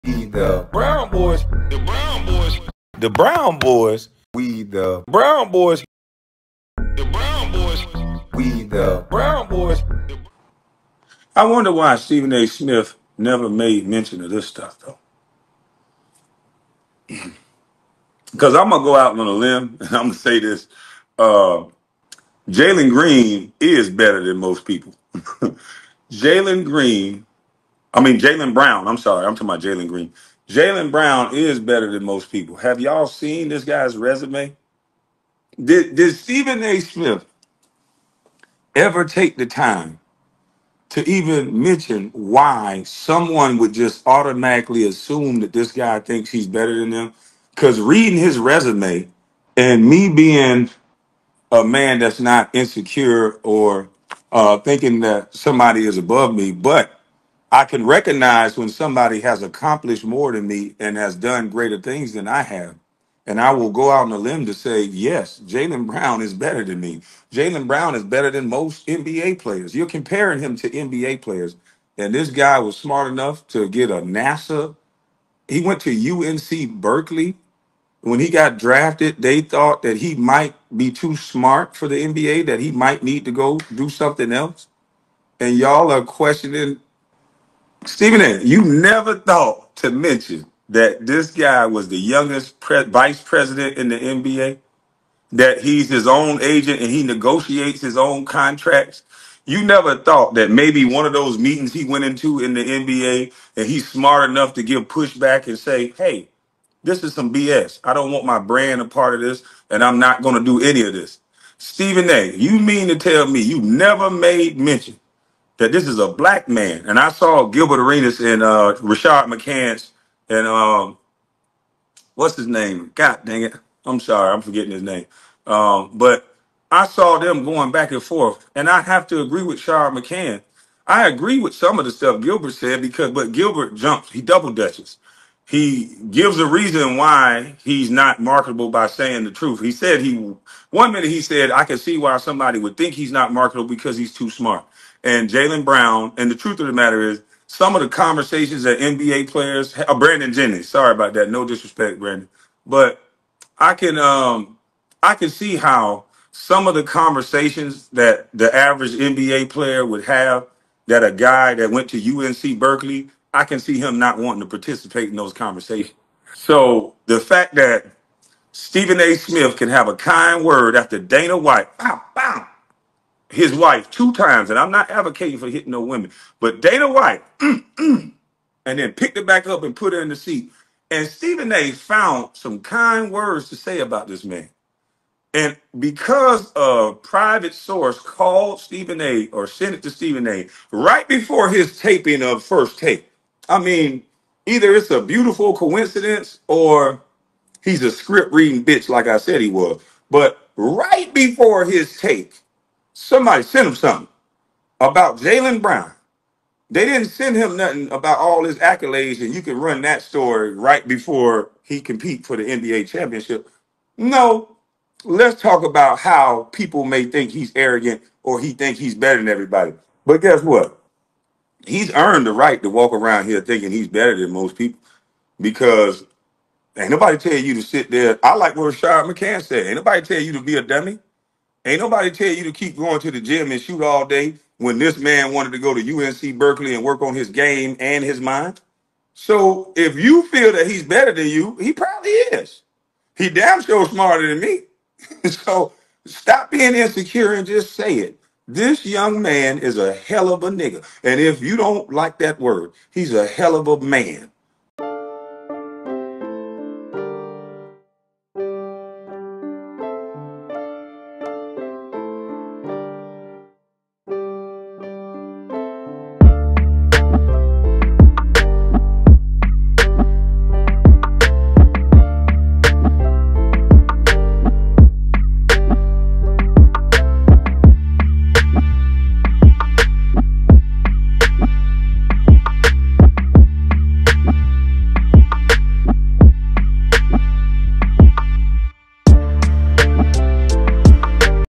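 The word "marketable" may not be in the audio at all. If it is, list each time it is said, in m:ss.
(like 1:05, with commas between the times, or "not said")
2:18, 2:23.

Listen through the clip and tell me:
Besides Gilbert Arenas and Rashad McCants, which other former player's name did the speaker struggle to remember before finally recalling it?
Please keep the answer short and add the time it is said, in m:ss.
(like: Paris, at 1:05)
Brandon Jennings, at 2:29.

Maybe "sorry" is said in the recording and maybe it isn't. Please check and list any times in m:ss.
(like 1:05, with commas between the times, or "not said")
0:28, 2:03, 2:30.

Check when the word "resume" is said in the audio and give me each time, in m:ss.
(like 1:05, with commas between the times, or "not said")
0:33, 0:48.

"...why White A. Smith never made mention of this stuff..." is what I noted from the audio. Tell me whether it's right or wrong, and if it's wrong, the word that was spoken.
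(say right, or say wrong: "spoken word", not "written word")
wrong: "Stephen", not "White".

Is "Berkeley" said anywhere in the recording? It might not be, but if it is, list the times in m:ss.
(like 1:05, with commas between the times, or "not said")
1:16, 2:42, 3:56.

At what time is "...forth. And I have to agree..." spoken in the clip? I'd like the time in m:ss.
2:08.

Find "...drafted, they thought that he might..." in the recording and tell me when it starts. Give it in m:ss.
1:18.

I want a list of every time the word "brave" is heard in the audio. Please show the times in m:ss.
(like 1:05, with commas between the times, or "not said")
not said.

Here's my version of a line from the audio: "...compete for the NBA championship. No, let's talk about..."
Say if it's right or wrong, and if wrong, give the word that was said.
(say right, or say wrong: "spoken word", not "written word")
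right.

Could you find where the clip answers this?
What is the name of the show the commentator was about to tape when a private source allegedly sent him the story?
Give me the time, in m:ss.
3:12.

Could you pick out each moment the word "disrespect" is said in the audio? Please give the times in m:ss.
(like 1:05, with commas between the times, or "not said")
2:31.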